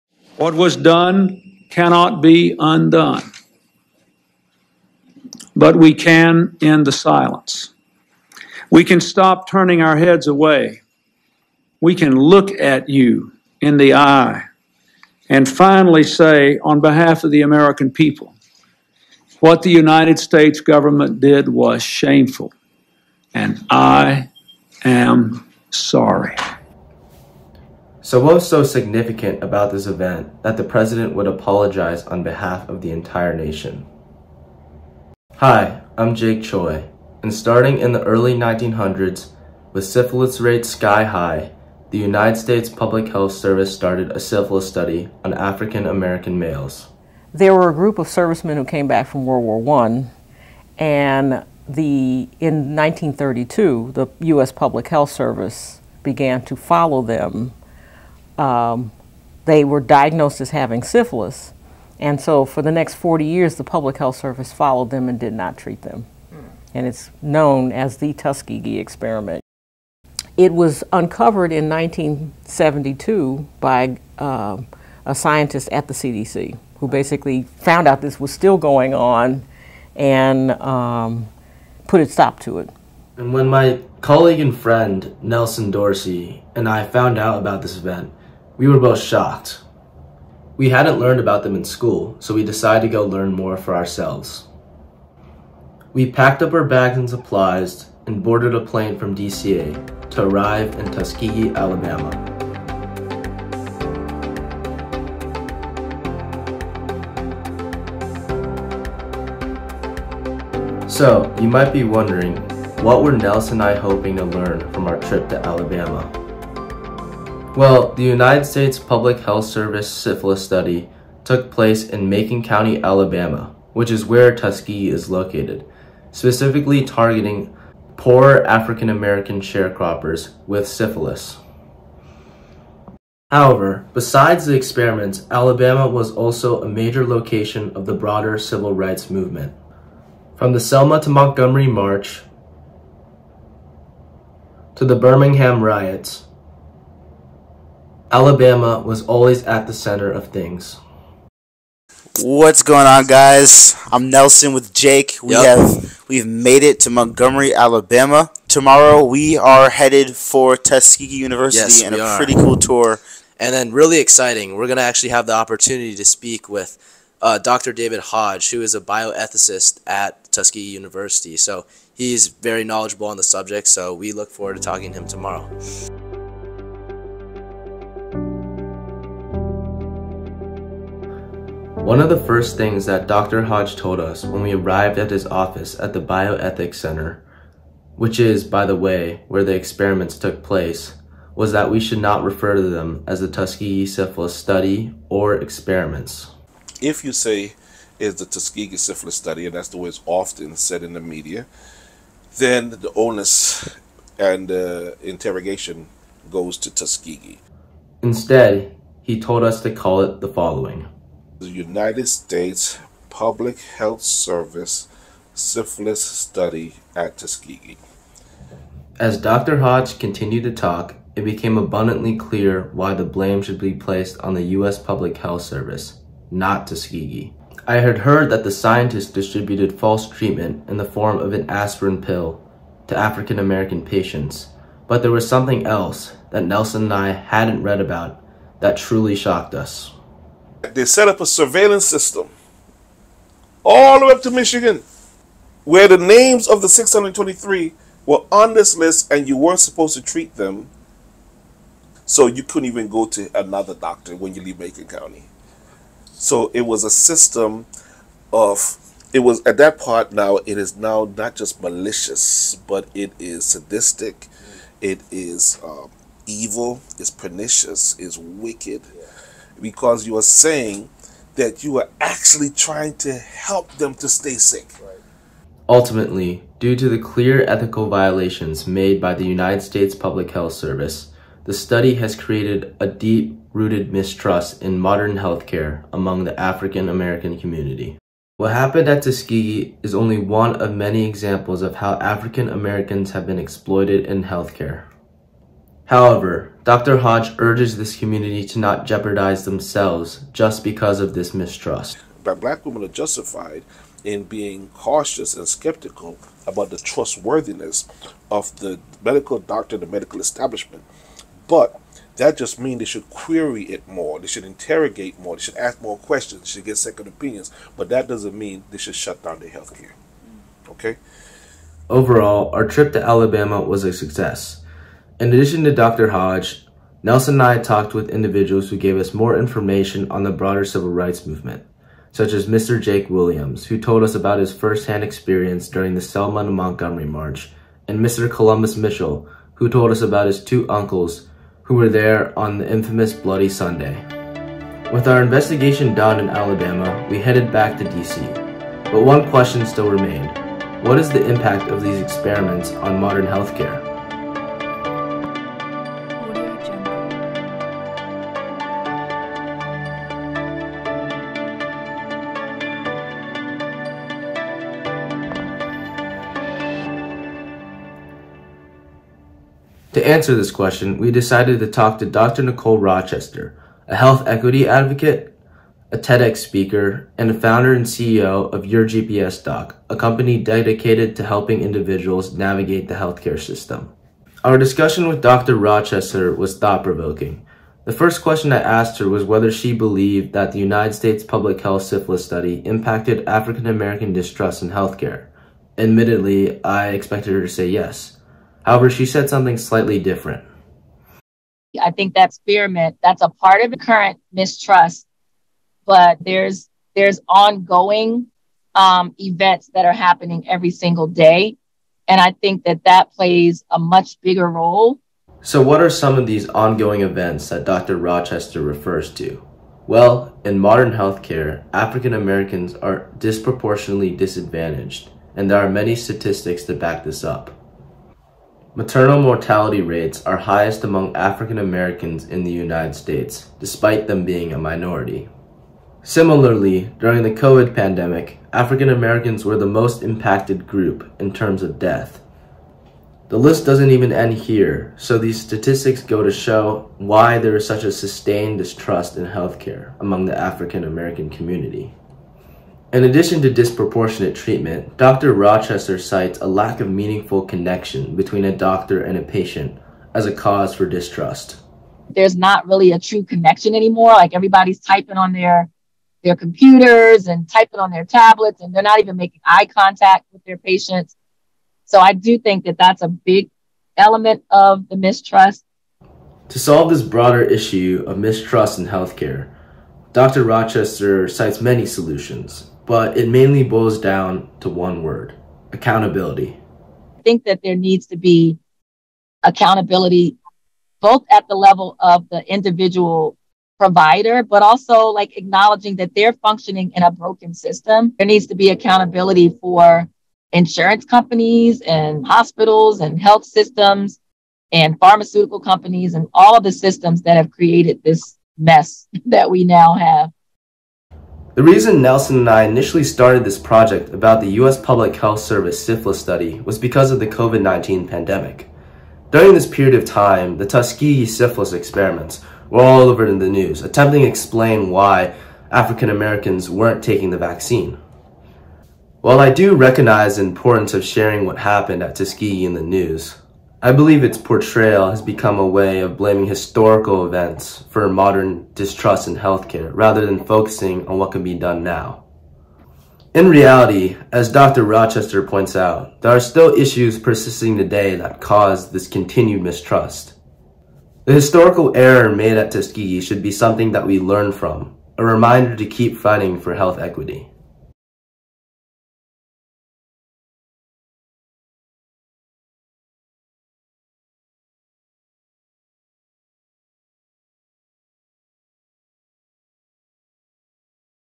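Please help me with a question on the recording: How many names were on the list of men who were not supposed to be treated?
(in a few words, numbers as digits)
623.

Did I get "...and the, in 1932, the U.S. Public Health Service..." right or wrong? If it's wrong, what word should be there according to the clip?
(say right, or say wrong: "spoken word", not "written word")
right.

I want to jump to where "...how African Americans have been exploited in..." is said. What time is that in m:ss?
4:51.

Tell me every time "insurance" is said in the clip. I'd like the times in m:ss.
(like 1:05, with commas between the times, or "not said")
8:20.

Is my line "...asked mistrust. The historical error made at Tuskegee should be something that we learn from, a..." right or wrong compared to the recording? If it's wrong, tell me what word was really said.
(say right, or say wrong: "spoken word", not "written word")
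wrong: "continued", not "asked".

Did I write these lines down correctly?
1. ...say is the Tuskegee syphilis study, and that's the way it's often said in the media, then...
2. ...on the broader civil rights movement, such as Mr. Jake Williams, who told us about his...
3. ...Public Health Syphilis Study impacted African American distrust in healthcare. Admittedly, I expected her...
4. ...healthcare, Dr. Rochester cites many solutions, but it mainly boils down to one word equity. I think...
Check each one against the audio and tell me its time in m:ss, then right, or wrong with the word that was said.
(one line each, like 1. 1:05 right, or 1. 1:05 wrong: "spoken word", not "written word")
1. 3:17 right
2. 5:30 right
3. 6:31 right
4. 7:58 wrong: "accountability", not "equity".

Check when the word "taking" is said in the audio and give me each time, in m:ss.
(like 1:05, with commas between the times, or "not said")
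8:47.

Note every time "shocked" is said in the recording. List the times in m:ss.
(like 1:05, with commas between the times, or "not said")
1:28, 3:59.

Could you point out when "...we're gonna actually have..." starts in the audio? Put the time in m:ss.
2:44.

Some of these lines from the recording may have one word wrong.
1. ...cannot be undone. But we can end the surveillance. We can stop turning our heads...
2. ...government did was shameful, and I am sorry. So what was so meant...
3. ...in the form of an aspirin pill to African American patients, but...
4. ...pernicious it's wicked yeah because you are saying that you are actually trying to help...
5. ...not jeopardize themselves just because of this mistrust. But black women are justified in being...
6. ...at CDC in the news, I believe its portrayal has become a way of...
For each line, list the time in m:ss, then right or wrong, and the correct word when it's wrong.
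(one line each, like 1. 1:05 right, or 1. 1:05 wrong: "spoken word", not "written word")
1. 0:01 wrong: "silence", not "surveillance"
2. 0:20 wrong: "significant", not "meant"
3. 3:50 right
4. 4:27 right
5. 4:58 right
6. 8:52 wrong: "Tuskegee", not "CDC".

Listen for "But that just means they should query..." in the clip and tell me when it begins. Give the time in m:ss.
5:11.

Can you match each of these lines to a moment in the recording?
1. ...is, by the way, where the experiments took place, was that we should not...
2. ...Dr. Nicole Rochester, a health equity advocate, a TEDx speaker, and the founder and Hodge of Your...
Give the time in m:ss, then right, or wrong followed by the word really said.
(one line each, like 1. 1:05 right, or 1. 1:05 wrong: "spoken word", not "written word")
1. 3:08 right
2. 6:12 wrong: "CEO", not "Hodge".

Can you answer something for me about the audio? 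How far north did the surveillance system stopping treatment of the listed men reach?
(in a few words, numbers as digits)
Michigan.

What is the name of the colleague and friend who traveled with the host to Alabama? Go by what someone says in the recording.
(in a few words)
Nelson Dorsey.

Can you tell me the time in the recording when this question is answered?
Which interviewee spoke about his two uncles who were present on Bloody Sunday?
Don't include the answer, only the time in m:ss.
5:38.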